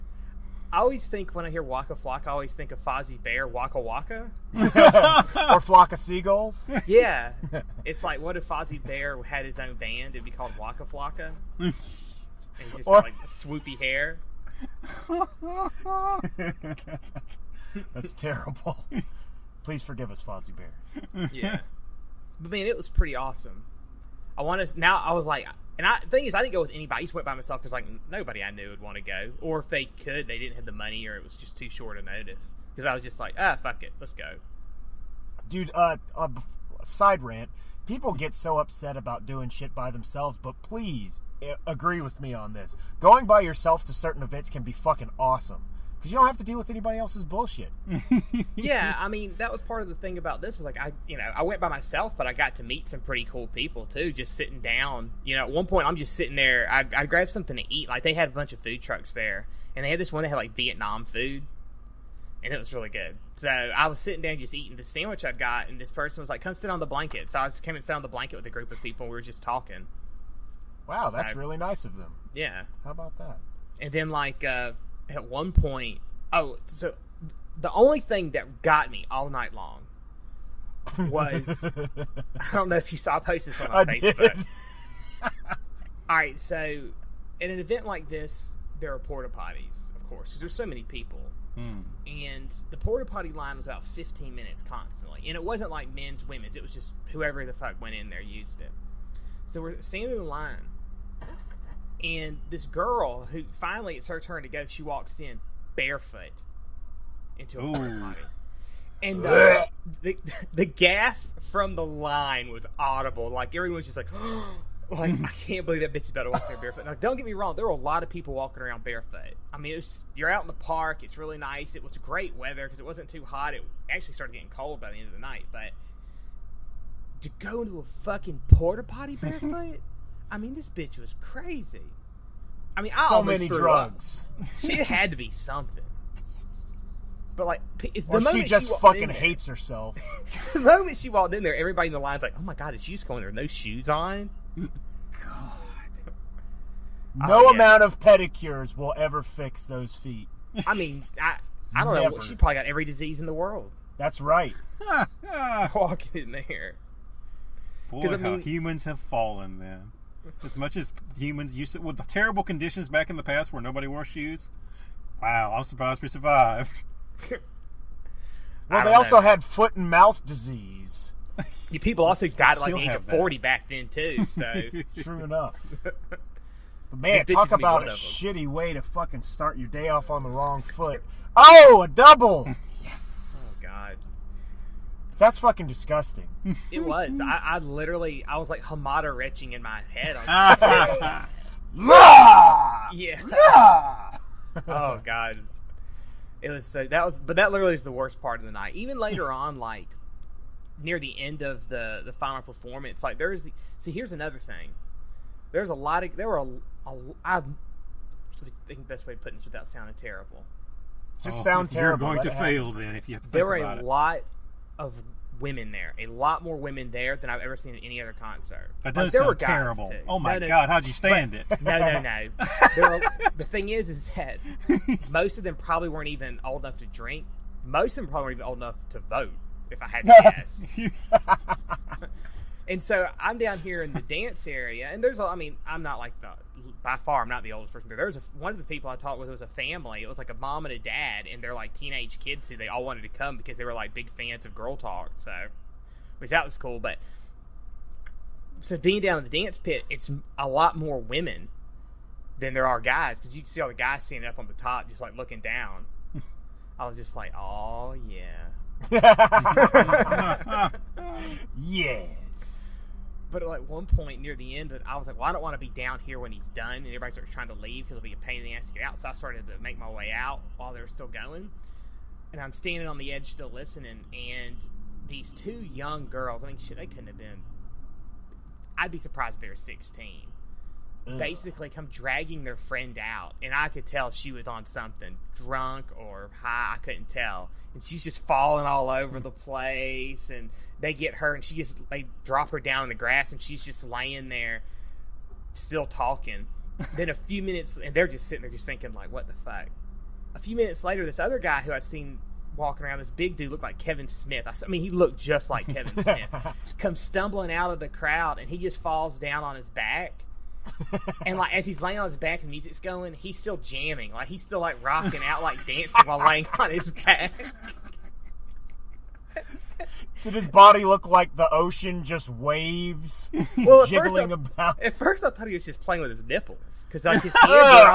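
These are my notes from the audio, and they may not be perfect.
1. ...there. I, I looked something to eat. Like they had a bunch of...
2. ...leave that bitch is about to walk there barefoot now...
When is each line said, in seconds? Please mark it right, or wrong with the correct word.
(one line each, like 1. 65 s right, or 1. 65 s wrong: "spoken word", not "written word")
1. 56 s wrong: "grabbed", not "looked"
2. 115 s wrong: "believe", not "leave".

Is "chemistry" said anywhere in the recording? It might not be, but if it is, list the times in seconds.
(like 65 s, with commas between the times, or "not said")
not said.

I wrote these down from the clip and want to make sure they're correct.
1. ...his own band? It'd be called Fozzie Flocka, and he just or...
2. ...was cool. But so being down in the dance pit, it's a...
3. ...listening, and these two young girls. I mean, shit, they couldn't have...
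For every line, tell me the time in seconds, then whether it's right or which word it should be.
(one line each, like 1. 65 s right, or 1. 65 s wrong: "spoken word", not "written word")
1. 9 s wrong: "Waka", not "Fozzie"
2. 246 s right
3. 273 s right.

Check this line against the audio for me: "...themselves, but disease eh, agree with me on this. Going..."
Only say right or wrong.
wrong.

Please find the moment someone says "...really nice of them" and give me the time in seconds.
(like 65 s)
71 s.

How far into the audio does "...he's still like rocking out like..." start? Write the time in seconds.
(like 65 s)
314 s.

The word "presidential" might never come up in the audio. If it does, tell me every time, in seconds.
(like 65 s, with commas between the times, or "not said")
not said.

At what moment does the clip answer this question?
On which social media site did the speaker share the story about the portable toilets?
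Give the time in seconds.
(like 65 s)
83 s.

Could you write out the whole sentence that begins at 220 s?
Oh my no, no, god, how'd you stand but, it?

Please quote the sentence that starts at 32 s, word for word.
Because I was just like, ah, fuck it, let's go.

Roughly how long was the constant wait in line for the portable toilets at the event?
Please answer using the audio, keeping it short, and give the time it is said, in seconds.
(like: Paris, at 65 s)
About 15 minutes, at 93 s.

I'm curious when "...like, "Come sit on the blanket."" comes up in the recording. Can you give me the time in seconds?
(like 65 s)
66 s.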